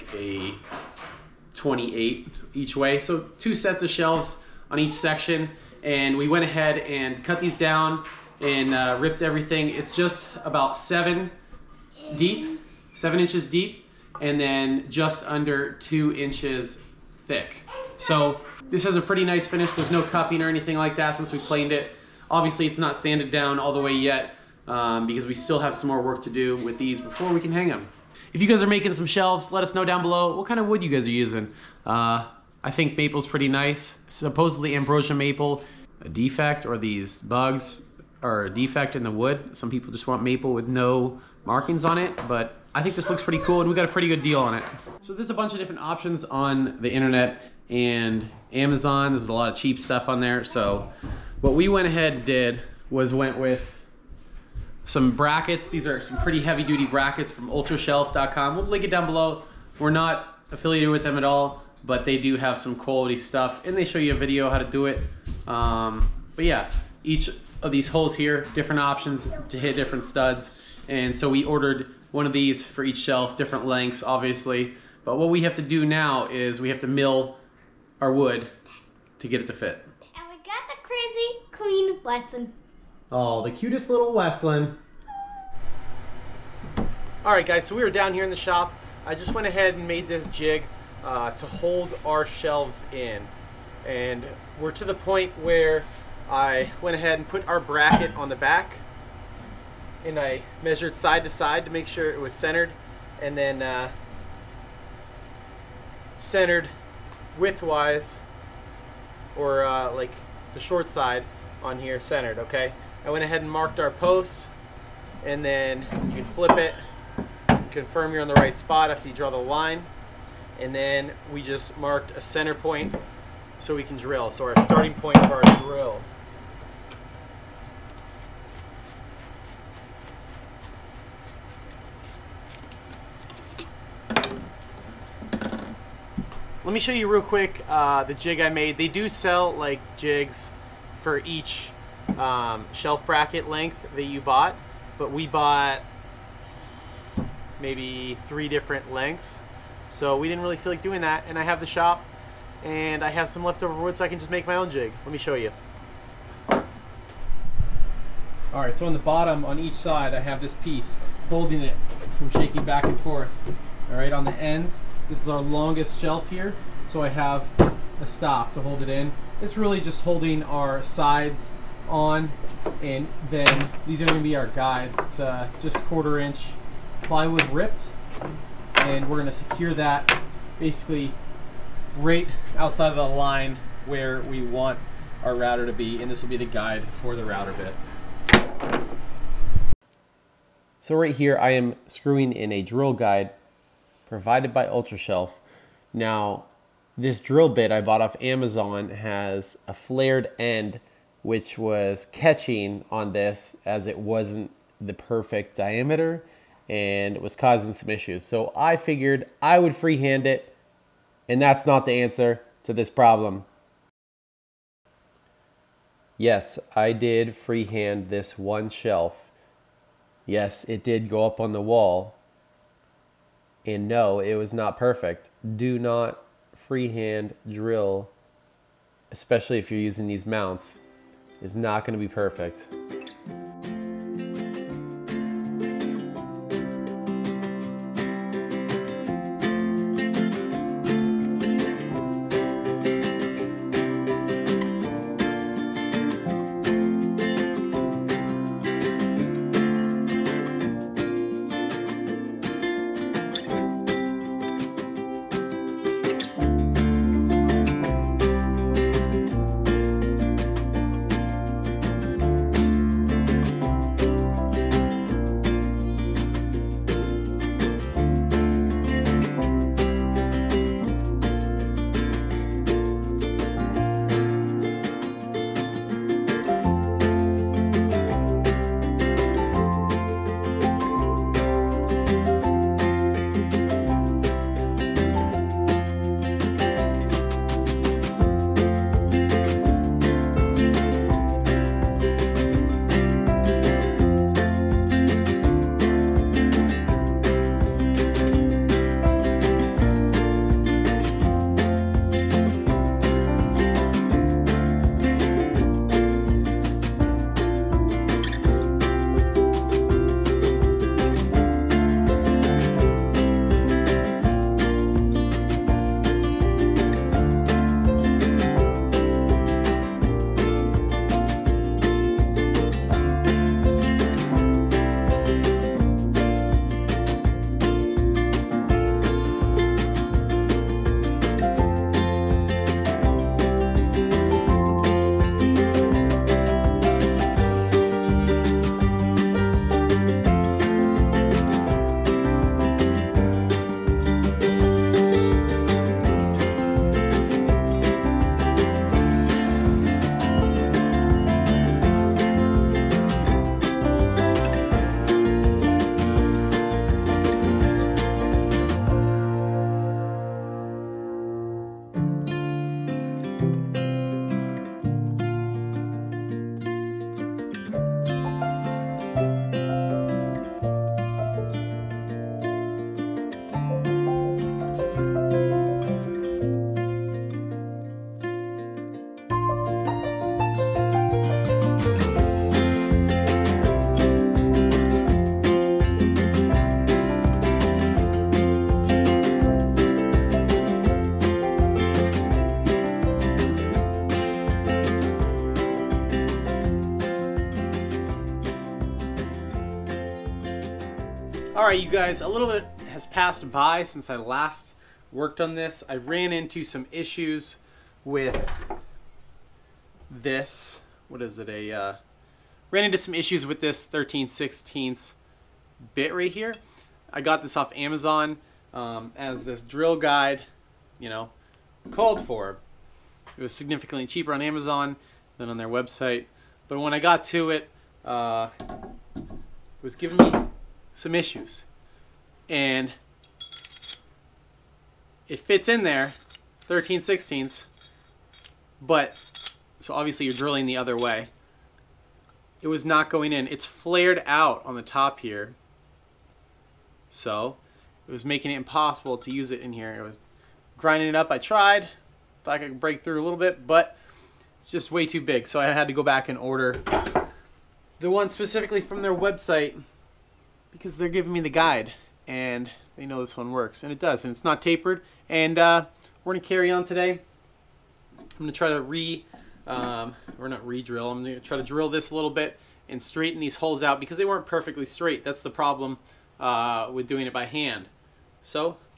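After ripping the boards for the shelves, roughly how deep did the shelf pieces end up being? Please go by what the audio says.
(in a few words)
7 inches.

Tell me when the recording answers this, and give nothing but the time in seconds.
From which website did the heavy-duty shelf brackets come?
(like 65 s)
57 s.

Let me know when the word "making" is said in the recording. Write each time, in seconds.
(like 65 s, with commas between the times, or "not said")
28 s, 448 s.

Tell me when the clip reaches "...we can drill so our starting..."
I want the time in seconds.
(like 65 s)
123 s.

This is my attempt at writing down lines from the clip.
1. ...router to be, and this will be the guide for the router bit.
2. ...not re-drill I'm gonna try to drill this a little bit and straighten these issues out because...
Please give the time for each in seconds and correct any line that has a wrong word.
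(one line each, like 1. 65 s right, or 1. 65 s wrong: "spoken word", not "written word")
1. 185 s right
2. 470 s wrong: "holes", not "issues".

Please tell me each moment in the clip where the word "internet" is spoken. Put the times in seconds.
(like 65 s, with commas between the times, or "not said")
46 s.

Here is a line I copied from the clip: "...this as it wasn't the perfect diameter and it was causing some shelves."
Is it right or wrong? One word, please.
wrong.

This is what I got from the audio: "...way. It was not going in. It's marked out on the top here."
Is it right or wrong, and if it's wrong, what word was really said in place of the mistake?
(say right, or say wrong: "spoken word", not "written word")
wrong: "flared", not "marked".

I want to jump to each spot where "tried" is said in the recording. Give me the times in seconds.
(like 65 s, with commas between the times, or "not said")
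451 s.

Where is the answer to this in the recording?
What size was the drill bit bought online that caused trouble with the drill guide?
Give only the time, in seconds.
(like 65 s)
413 s.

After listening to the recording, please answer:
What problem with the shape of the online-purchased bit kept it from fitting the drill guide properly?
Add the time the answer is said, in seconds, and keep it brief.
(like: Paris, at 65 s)
flared end, at 199 s.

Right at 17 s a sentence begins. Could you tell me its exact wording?
So this has a pretty nice finish.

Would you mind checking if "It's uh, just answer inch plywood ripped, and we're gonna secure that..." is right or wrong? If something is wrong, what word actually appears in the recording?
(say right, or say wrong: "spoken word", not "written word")
wrong: "quarter", not "answer".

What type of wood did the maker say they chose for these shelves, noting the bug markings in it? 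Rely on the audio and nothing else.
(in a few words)
ambrosia maple.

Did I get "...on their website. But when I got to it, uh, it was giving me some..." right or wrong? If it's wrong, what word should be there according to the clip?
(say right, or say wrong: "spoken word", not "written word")
right.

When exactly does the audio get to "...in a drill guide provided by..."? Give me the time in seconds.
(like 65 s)
192 s.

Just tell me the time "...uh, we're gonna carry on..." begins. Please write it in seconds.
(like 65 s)
465 s.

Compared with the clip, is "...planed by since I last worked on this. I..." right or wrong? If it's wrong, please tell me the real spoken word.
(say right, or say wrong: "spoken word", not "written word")
wrong: "passed", not "planed".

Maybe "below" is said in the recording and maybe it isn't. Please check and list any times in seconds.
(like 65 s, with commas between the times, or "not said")
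30 s, 59 s.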